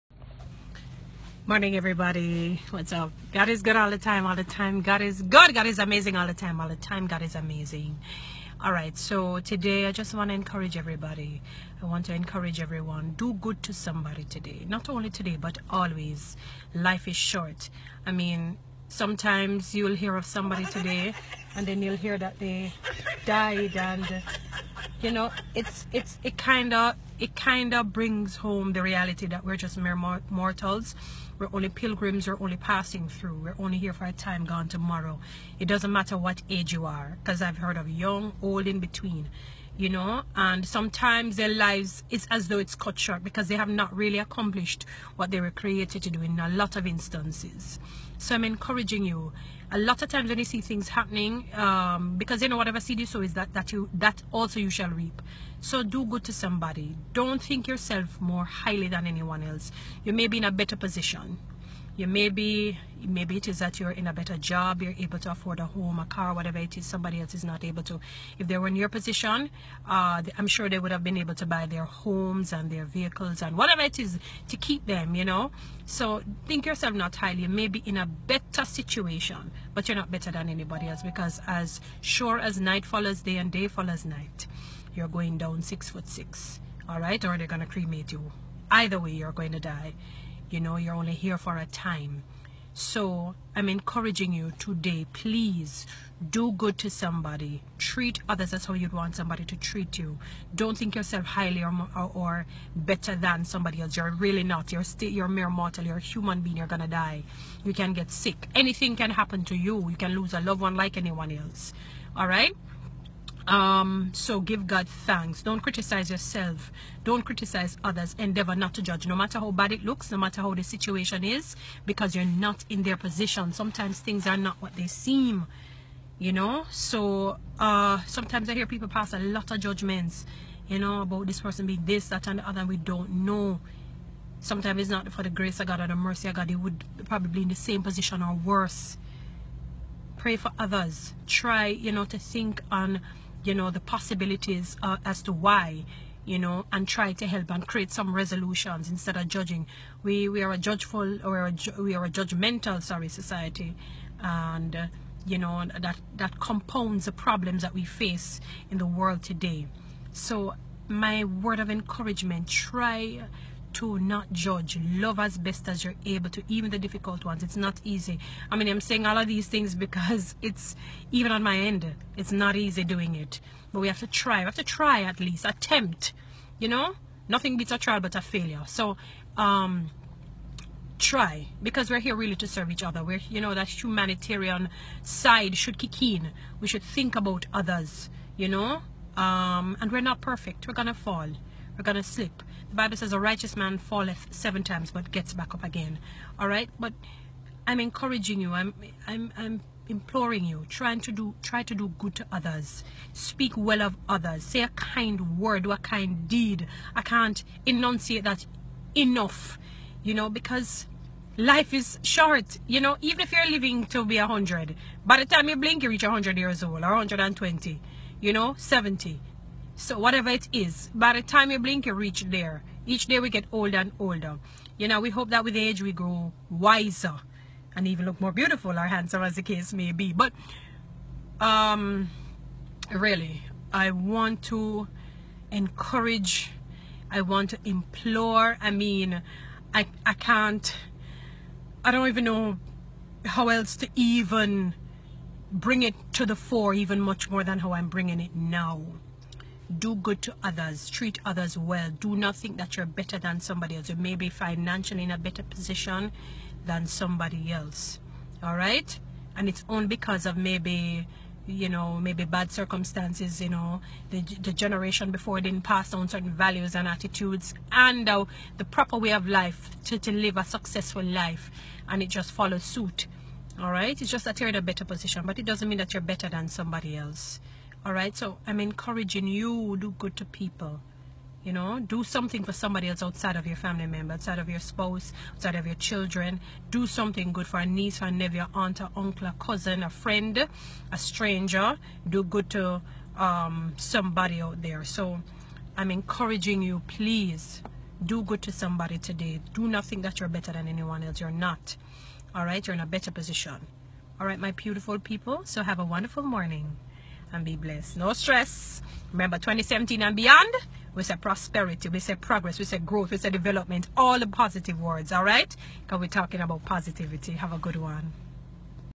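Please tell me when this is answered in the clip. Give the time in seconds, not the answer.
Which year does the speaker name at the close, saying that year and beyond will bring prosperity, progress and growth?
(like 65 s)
309 s.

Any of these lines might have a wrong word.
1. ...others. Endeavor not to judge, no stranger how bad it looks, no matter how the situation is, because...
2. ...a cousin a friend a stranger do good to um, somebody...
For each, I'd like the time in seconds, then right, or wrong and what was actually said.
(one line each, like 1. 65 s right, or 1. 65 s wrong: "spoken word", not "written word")
1. 117 s wrong: "matter", not "stranger"
2. 289 s right.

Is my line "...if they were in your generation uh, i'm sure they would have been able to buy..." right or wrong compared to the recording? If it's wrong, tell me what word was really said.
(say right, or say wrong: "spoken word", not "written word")
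wrong: "position", not "generation".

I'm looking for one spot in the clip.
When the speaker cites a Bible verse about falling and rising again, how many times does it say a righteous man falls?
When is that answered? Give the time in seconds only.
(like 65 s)
194 s.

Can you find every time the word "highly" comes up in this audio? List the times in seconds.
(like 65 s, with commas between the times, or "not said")
58 s, 77 s, 101 s.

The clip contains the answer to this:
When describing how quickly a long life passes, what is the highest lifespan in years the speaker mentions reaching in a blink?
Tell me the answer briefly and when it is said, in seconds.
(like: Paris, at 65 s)
120, at 216 s.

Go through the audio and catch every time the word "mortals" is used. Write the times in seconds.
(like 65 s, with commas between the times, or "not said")
30 s, 105 s.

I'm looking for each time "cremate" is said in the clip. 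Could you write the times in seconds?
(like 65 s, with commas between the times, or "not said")
87 s.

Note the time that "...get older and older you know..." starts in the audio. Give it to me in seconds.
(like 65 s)
223 s.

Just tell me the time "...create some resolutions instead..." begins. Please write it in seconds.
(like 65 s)
147 s.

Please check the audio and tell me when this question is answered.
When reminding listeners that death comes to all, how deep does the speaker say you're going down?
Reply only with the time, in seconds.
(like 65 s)
85 s.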